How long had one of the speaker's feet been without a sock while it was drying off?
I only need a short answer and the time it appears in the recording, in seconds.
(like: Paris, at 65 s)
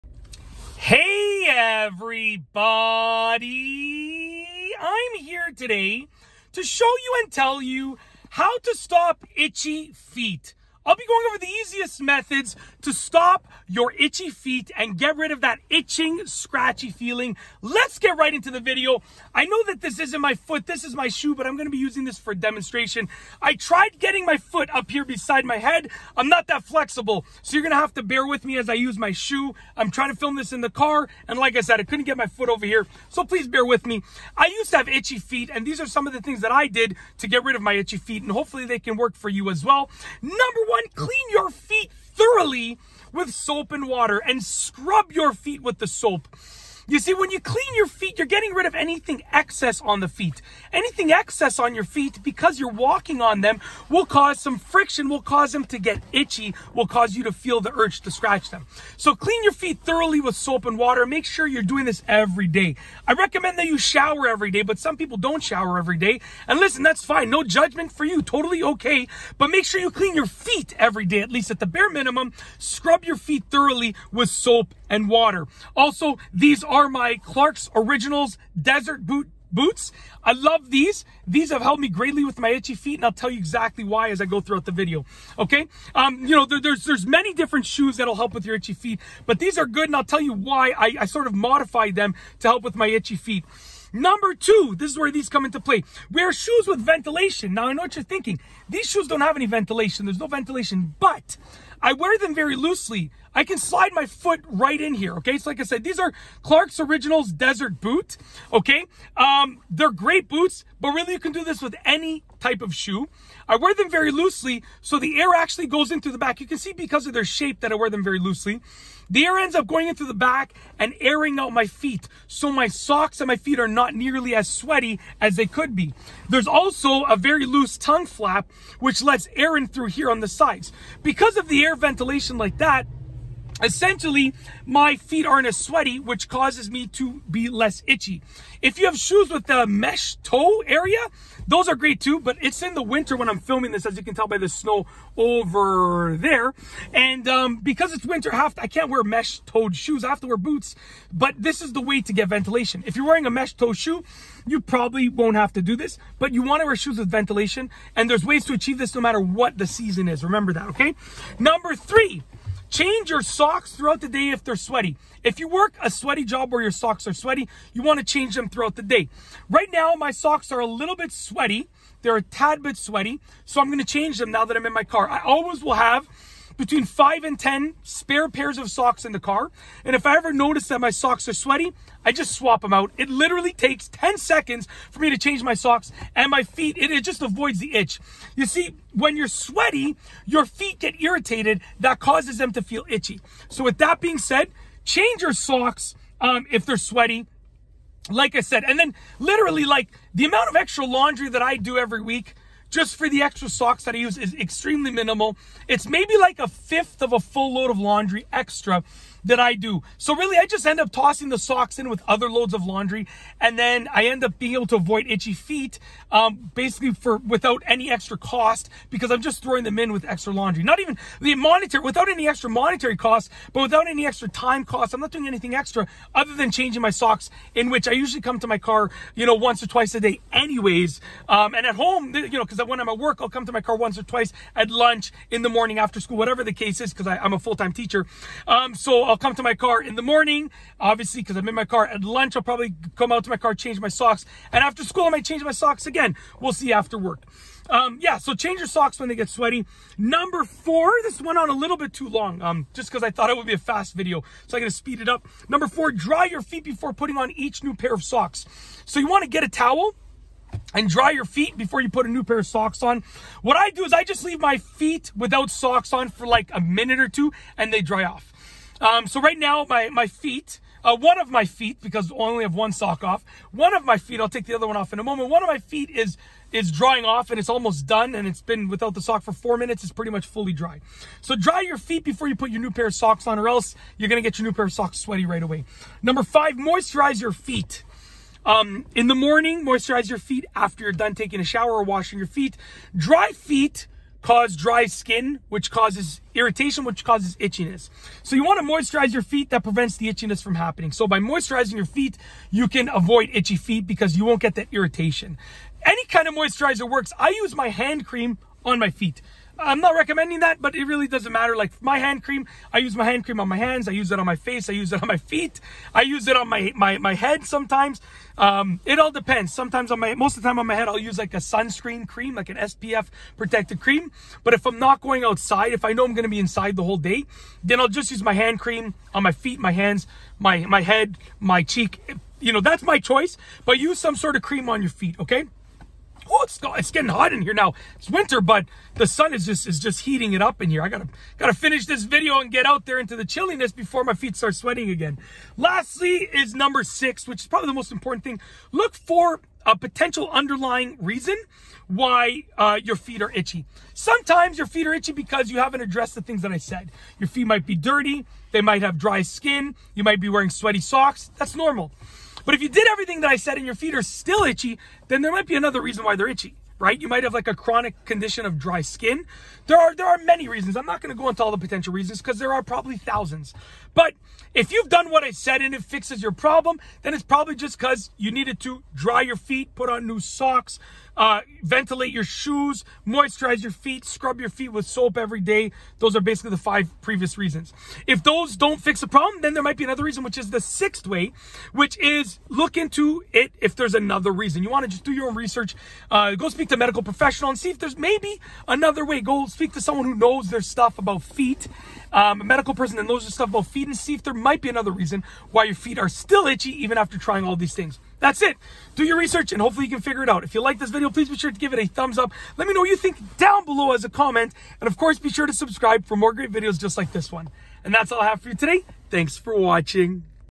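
4 minutes, at 279 s.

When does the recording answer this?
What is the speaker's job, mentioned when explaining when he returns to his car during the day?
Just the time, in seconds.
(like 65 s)
237 s.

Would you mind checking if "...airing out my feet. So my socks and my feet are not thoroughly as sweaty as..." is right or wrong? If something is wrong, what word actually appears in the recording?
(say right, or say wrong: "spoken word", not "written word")
wrong: "nearly", not "thoroughly".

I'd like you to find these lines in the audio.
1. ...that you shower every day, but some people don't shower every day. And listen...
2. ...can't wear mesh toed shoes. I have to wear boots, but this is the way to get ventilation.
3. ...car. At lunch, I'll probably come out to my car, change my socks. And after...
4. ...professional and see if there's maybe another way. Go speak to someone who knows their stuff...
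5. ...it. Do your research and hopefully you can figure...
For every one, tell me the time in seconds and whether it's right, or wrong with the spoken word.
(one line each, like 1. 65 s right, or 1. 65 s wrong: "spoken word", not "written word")
1. 63 s right
2. 148 s right
3. 241 s right
4. 397 s right
5. 408 s right.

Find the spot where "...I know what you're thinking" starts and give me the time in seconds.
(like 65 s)
97 s.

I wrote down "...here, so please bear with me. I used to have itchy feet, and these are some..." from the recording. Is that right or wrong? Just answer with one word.
right.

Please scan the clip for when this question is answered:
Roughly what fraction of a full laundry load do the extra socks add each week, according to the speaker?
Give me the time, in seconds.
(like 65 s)
206 s.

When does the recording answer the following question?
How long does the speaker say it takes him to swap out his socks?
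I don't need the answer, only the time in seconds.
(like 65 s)
183 s.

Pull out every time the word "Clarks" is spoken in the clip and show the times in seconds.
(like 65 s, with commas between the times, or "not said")
77 s, 106 s.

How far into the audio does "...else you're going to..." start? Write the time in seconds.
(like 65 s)
283 s.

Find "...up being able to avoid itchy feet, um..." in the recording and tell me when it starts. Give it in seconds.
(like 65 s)
214 s.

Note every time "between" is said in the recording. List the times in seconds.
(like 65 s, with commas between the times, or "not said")
176 s.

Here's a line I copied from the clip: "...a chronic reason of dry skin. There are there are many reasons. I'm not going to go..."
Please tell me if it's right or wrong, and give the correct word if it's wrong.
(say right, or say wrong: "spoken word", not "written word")
wrong: "condition", not "reason".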